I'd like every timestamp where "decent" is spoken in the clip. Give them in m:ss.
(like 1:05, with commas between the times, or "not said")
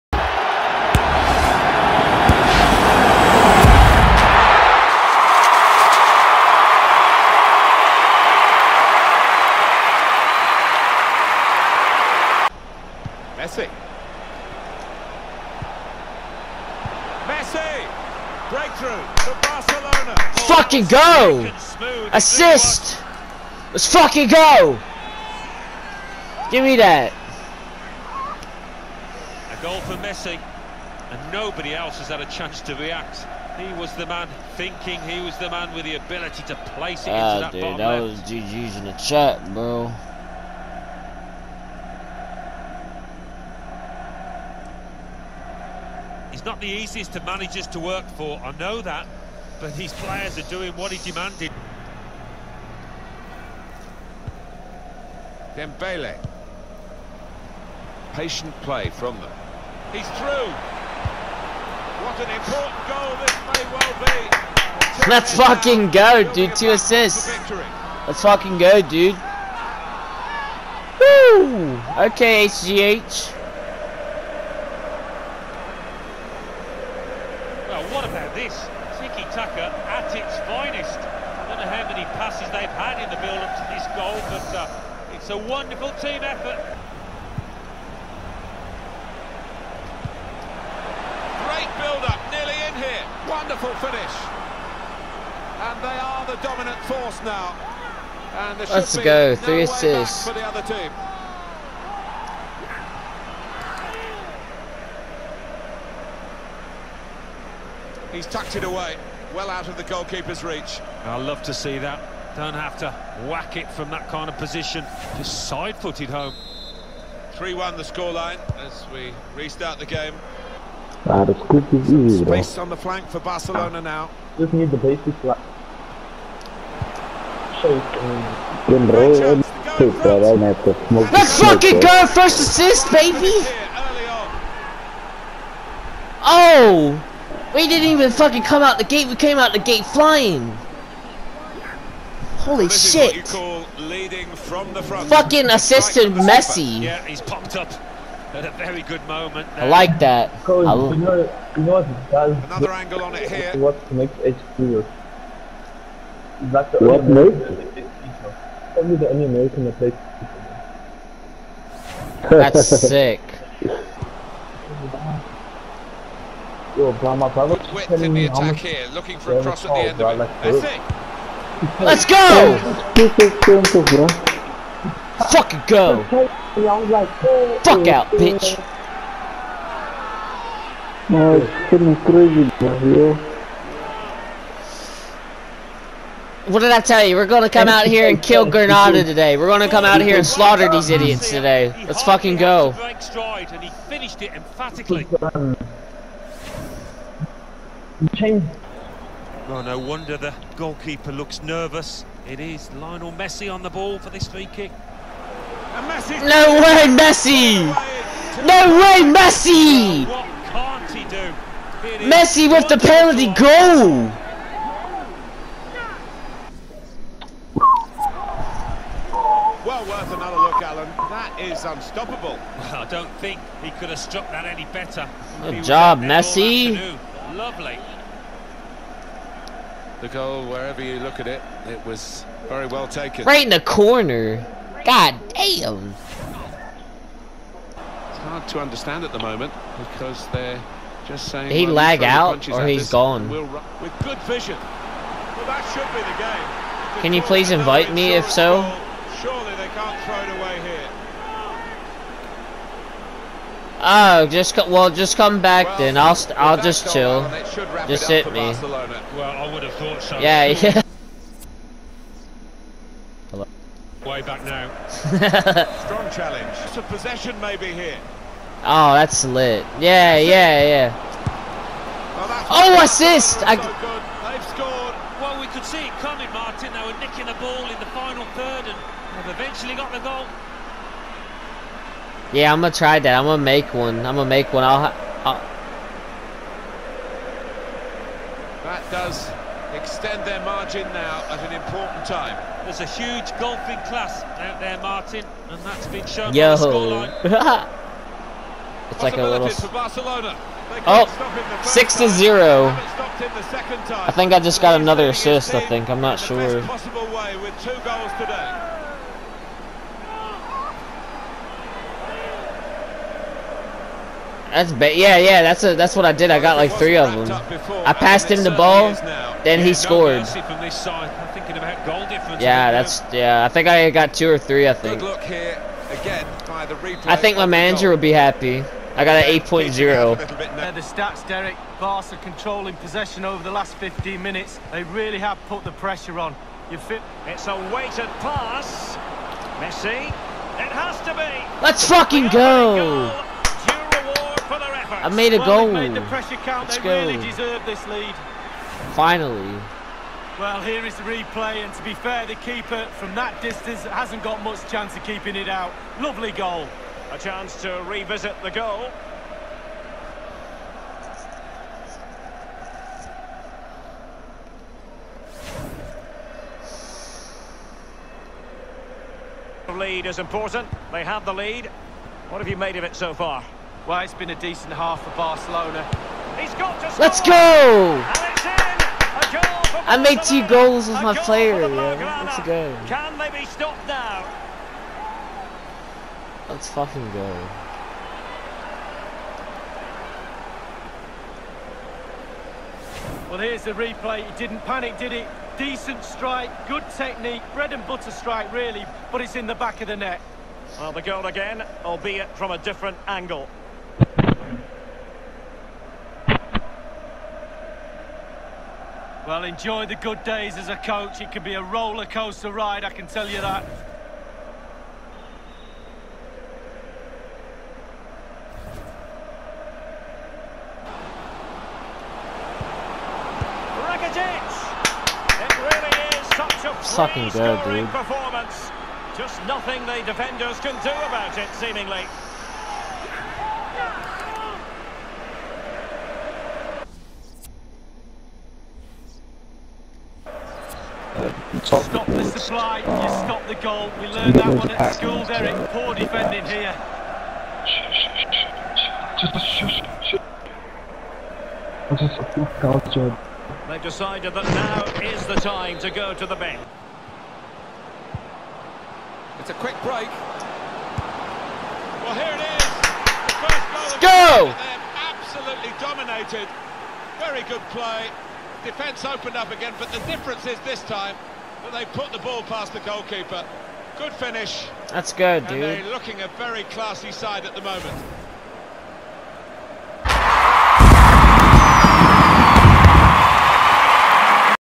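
6:14, 6:35.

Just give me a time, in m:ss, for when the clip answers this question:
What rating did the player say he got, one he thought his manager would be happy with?
5:29.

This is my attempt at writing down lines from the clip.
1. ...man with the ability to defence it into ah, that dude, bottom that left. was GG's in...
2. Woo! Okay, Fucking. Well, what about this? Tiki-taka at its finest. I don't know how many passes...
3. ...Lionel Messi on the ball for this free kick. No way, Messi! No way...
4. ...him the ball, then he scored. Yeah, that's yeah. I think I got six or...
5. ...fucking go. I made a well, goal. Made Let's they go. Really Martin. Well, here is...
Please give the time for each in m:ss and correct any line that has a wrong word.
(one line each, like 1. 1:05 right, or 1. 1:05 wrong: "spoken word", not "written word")
1. 0:35 wrong: "place", not "defence"
2. 1:10 wrong: "HGH", not "Fucking"
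3. 3:22 right
4. 5:18 wrong: "two", not "six"
5. 5:41 wrong: "Finally", not "Martin".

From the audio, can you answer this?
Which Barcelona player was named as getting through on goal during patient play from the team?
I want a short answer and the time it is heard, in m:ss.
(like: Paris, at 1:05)
Dembele, at 0:55.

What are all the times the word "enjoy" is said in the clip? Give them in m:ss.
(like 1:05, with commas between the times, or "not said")
6:49.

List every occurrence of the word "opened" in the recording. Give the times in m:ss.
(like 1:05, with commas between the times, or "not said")
7:49.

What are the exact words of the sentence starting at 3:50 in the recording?
The goal, wherever you look at it, it was very well taken.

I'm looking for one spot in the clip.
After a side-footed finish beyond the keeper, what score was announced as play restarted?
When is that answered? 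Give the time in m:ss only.
1:57.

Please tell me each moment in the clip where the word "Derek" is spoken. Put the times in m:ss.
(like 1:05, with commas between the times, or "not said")
5:31, 7:25.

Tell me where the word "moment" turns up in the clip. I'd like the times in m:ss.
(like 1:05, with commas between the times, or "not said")
2:29, 3:59, 7:57.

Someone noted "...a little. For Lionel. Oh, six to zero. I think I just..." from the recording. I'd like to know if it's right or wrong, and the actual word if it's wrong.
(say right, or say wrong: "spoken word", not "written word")
wrong: "Barcelona", not "Lionel".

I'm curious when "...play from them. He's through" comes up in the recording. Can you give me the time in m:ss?
0:58.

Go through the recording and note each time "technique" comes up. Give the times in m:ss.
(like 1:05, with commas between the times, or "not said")
6:36.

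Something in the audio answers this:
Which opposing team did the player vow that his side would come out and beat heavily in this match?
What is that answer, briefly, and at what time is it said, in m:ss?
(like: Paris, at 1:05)
Granada, at 3:08.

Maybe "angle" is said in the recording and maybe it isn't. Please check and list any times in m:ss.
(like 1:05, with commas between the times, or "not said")
2:32, 6:43.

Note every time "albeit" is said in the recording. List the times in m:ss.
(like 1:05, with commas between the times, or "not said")
6:41.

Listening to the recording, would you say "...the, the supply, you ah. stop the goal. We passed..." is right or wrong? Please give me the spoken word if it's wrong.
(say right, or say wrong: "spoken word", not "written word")
wrong: "learned", not "passed".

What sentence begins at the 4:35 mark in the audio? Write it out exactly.
Well, we could see it coming, Martin.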